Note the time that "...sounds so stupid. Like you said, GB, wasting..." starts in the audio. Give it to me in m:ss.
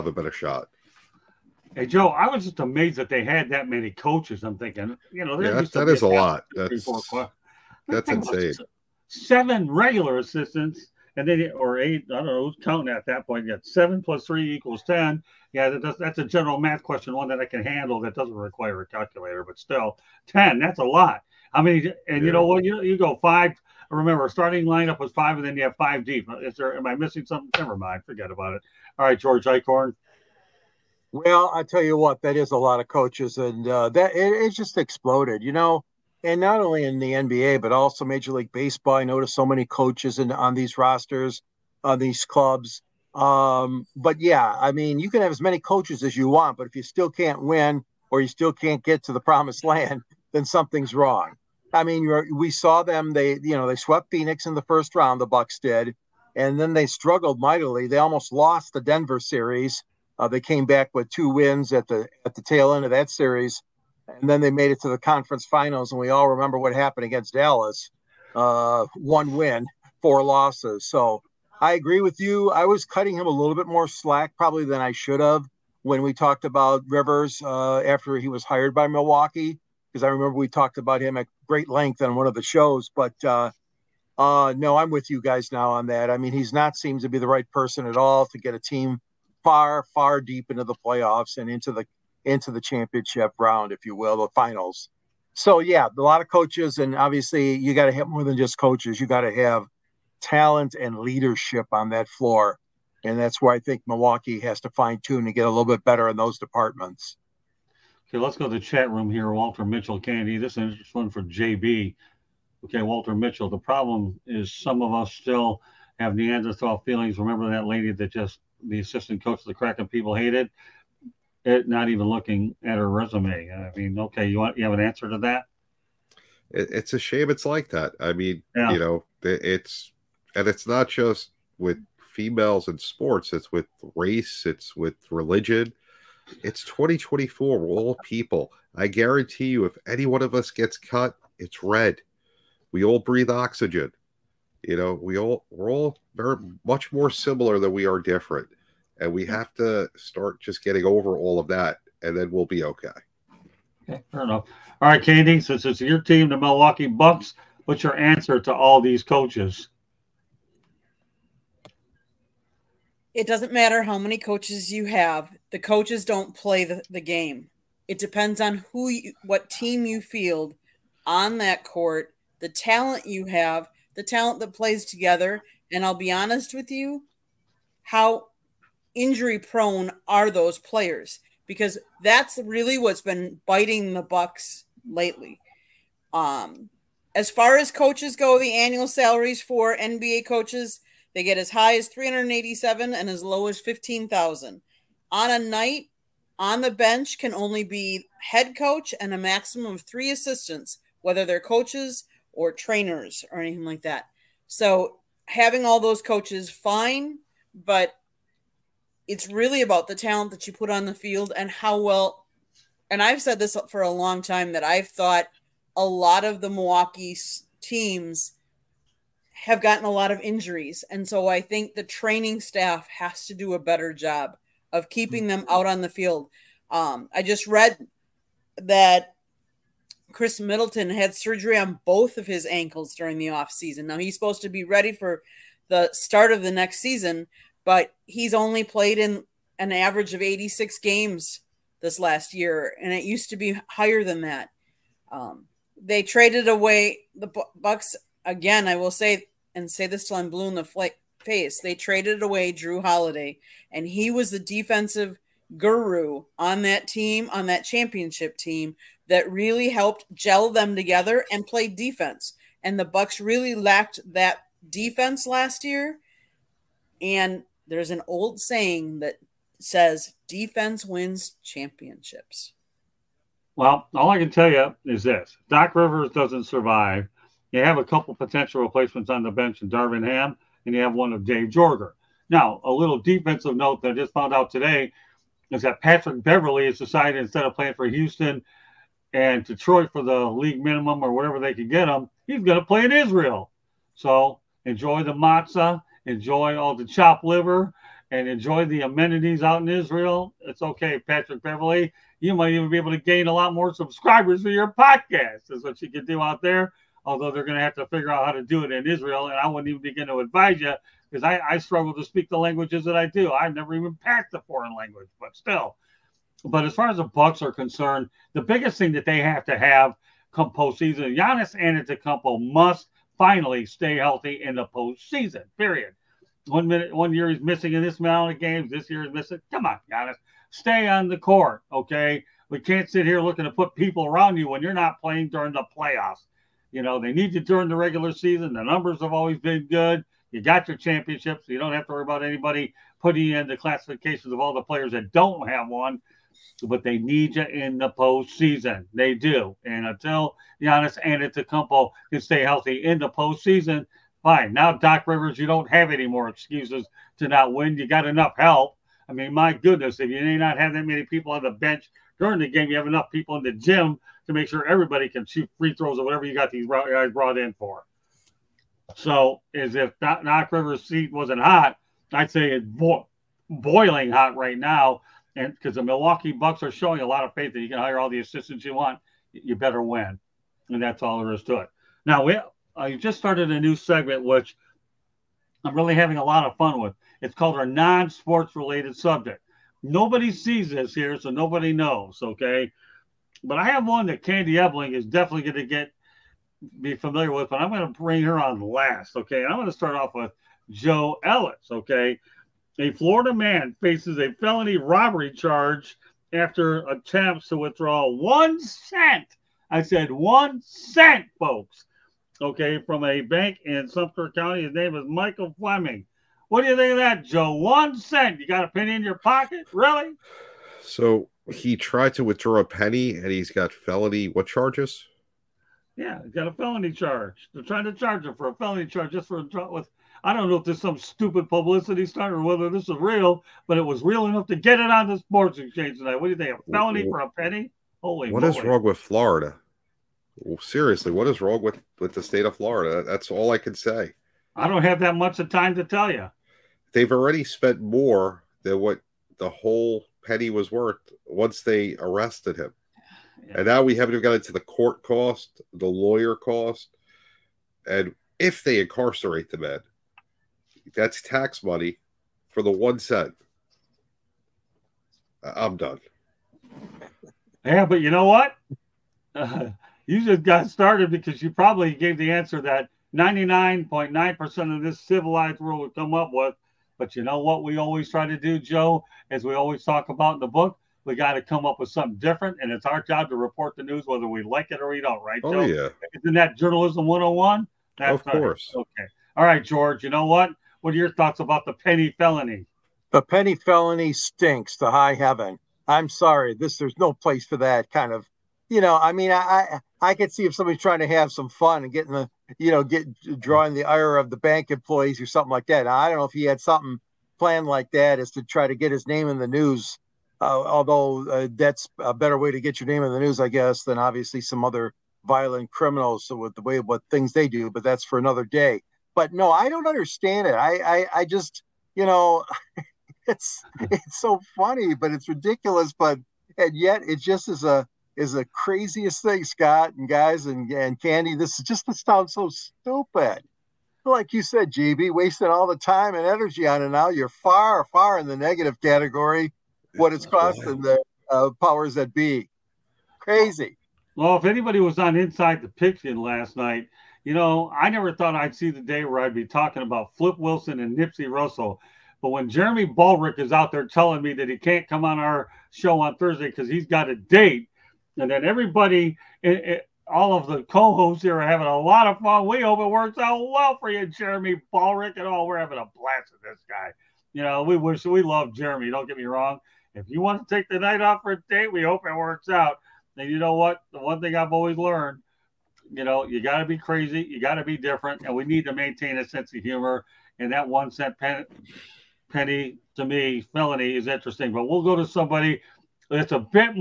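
8:52.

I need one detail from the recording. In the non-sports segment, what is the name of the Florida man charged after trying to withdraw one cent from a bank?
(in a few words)
Michael Fleming.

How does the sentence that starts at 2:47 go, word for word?
It depends on who you, what team you field on that court, the talent you have, the talent that plays together.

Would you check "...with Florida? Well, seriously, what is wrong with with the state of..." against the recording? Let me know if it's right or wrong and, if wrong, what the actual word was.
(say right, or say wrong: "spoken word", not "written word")
right.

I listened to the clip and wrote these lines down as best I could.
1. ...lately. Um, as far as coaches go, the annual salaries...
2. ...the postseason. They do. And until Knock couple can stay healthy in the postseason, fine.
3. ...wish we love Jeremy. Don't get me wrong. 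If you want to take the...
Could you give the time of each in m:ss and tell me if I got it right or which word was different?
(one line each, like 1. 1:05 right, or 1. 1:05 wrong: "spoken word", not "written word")
1. 3:04 right
2. 5:47 wrong: "Giannis", not "Knock"
3. 9:27 right.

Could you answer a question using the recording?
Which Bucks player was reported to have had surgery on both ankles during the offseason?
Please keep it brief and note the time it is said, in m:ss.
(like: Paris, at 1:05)
Khris Middleton, at 3:50.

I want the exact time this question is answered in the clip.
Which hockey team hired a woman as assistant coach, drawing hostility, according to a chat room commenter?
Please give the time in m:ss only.
1:59.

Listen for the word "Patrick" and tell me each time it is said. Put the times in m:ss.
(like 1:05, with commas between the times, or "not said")
4:45, 5:00.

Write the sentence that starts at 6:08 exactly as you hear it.
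So, as if that Knock River seat wasn't hot, I'd say it's bo- boiling hot right now.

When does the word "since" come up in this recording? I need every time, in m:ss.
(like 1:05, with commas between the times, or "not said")
2:35.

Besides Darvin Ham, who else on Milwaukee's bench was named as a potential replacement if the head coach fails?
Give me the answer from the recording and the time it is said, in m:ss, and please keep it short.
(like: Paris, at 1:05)
Dave Joerger, at 4:41.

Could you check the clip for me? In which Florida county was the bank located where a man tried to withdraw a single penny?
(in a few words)
Sumter County.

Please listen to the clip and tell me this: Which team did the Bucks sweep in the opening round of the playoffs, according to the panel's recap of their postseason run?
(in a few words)
Phoenix.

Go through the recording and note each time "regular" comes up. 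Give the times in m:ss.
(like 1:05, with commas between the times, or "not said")
0:09, 5:37.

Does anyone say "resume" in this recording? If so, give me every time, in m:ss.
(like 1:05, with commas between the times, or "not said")
2:02.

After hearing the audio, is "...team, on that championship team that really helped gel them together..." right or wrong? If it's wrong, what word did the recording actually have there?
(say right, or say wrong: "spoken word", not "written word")
right.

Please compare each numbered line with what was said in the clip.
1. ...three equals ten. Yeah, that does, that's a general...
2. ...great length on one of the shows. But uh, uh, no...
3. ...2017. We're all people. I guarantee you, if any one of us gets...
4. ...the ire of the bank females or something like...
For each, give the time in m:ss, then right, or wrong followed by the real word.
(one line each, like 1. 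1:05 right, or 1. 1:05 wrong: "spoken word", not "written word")
1. 0:14 right
2. 1:21 right
3. 2:16 wrong: "2024", not "2017"
4. 8:23 wrong: "employees", not "females".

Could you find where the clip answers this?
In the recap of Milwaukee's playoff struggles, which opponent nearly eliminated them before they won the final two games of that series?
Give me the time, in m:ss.
0:58.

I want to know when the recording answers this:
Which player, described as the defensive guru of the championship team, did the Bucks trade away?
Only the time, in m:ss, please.
4:12.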